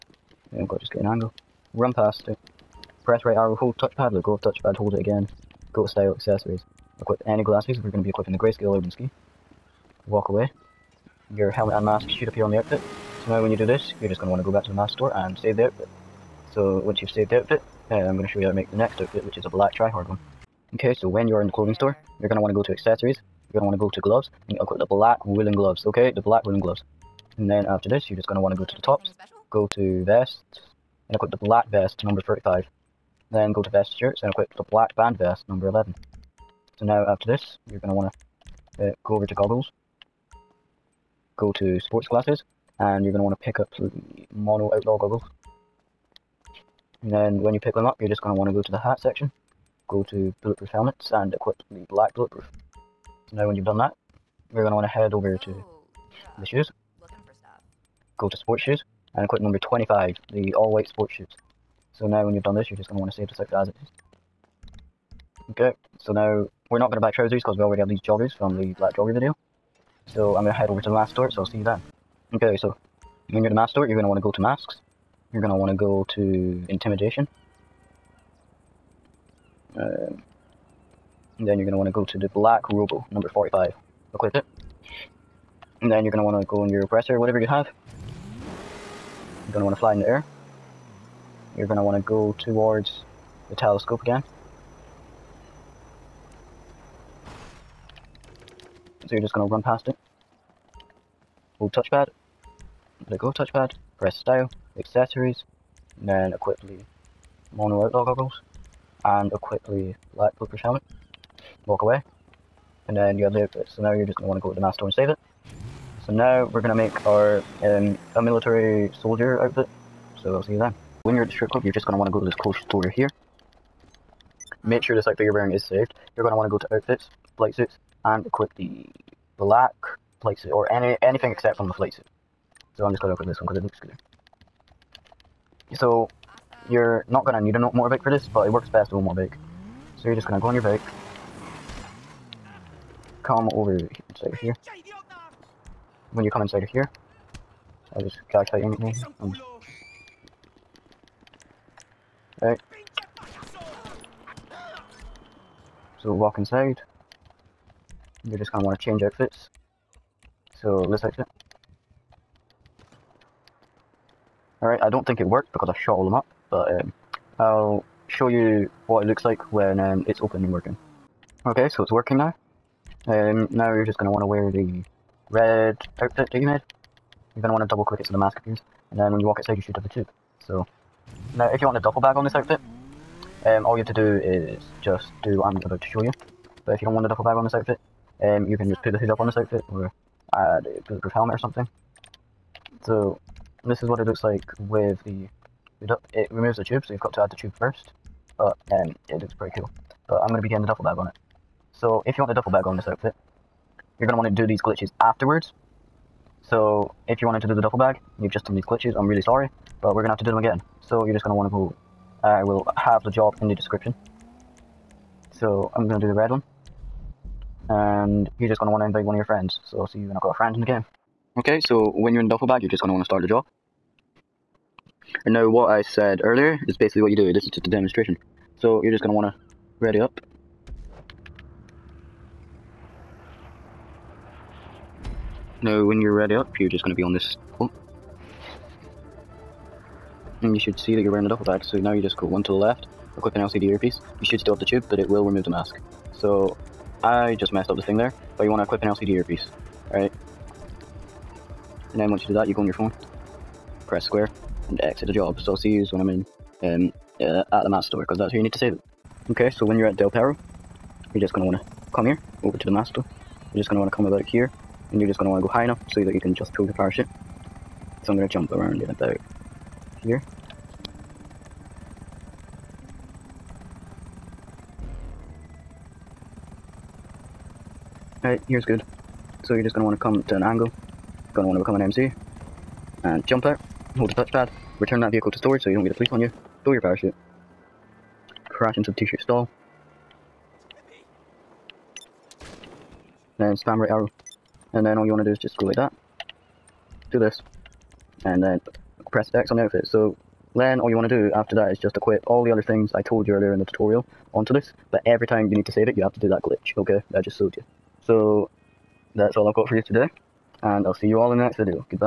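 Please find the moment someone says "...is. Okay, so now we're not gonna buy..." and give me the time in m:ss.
1:03.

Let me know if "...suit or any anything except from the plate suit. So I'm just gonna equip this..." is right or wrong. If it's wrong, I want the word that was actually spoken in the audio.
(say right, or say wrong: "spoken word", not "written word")
right.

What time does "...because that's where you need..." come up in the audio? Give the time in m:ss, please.
4:18.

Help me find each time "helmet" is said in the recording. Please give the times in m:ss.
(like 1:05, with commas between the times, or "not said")
0:11, 0:50, 1:50, 3:11.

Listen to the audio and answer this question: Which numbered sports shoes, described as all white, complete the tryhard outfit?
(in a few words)
25.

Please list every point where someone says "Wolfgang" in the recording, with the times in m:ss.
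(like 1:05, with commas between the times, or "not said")
not said.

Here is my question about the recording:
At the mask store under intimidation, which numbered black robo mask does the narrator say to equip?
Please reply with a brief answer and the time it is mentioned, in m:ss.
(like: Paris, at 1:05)
45, at 1:23.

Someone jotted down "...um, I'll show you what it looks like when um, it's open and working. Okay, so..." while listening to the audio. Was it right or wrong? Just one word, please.
right.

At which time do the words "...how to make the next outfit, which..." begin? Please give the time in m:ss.
0:18.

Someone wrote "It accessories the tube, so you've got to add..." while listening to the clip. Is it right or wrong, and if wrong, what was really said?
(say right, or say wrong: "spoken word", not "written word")
wrong: "removes", not "accessories".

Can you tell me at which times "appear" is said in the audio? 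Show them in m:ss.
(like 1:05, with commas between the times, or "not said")
0:12, 2:58.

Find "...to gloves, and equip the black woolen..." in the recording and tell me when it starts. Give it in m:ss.
0:23.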